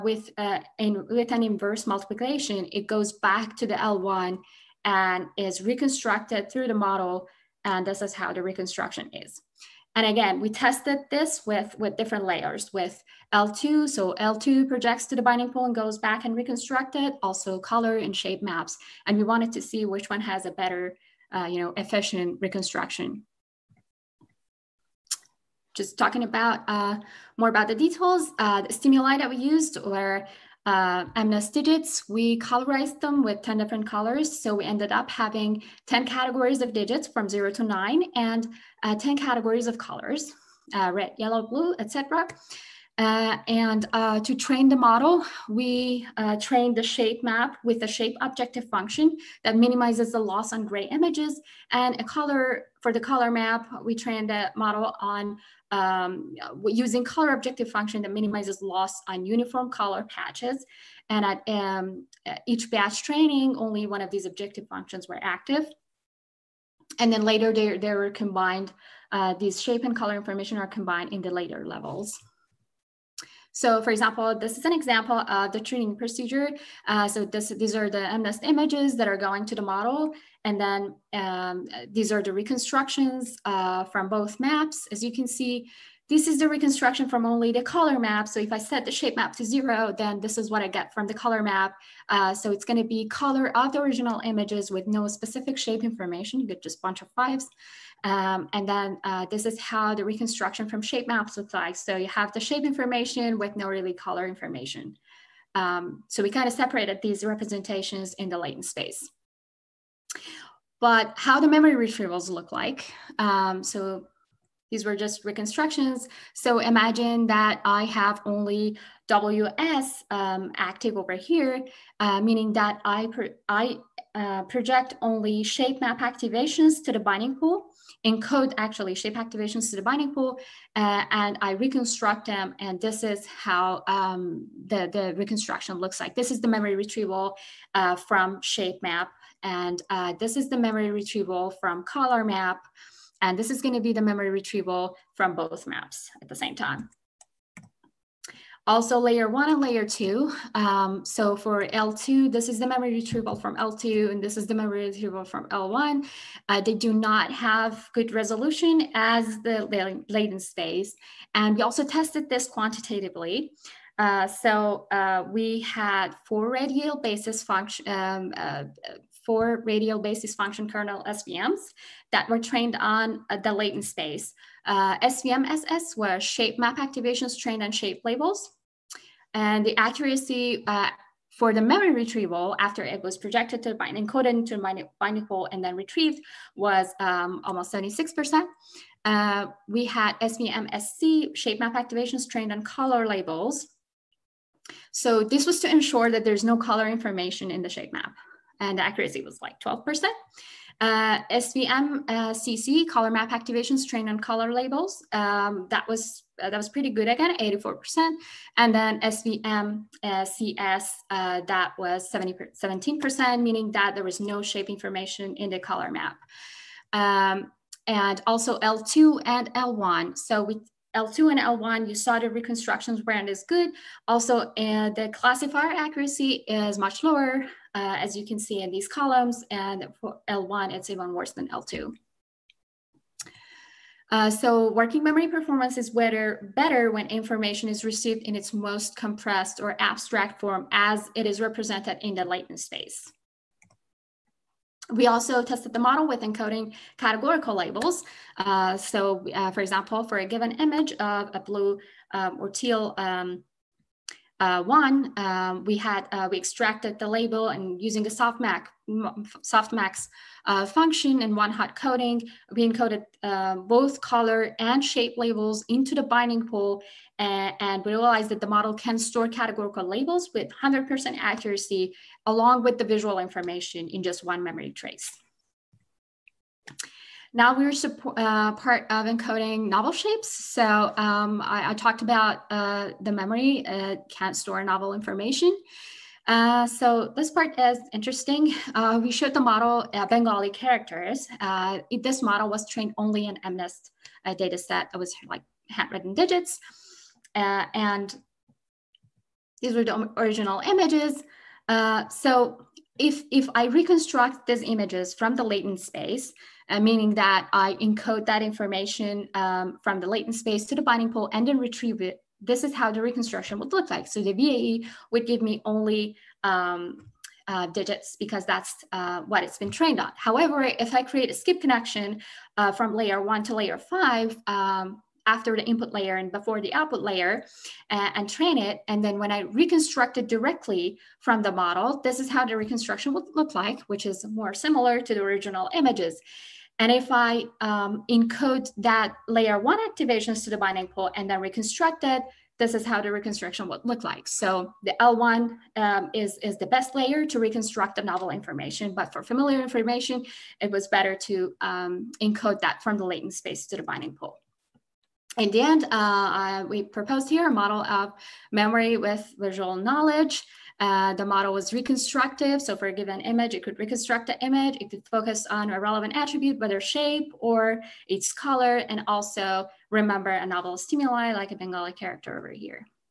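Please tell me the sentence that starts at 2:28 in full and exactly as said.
Also layer one and layer two.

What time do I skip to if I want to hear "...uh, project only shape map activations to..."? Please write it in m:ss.
2:04.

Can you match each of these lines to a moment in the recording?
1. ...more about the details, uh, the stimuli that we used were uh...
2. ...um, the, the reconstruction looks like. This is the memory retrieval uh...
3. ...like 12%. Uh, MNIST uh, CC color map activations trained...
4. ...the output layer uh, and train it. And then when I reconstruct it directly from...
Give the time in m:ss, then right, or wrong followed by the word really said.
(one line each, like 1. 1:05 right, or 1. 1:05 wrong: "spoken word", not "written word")
1. 0:27 right
2. 2:13 right
3. 3:19 wrong: "SVM", not "MNIST"
4. 5:26 right.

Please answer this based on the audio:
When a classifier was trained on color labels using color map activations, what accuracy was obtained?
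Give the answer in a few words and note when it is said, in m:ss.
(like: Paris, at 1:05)
84%, at 3:27.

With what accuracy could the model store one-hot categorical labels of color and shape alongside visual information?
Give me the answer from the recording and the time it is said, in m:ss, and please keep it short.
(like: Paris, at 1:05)
100%, at 4:30.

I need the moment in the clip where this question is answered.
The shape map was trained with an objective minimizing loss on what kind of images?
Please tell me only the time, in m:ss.
0:50.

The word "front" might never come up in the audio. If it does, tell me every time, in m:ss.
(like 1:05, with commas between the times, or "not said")
not said.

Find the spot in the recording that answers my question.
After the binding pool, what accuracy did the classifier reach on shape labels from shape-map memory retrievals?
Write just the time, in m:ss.
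3:07.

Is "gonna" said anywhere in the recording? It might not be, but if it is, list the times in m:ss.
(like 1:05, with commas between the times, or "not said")
1:32, 2:23.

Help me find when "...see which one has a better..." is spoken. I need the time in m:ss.
0:19.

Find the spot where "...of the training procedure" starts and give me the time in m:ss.
1:15.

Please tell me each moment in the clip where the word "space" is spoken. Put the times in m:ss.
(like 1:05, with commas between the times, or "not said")
1:48, 2:40, 2:53, 4:02, 5:05, 5:10, 5:53.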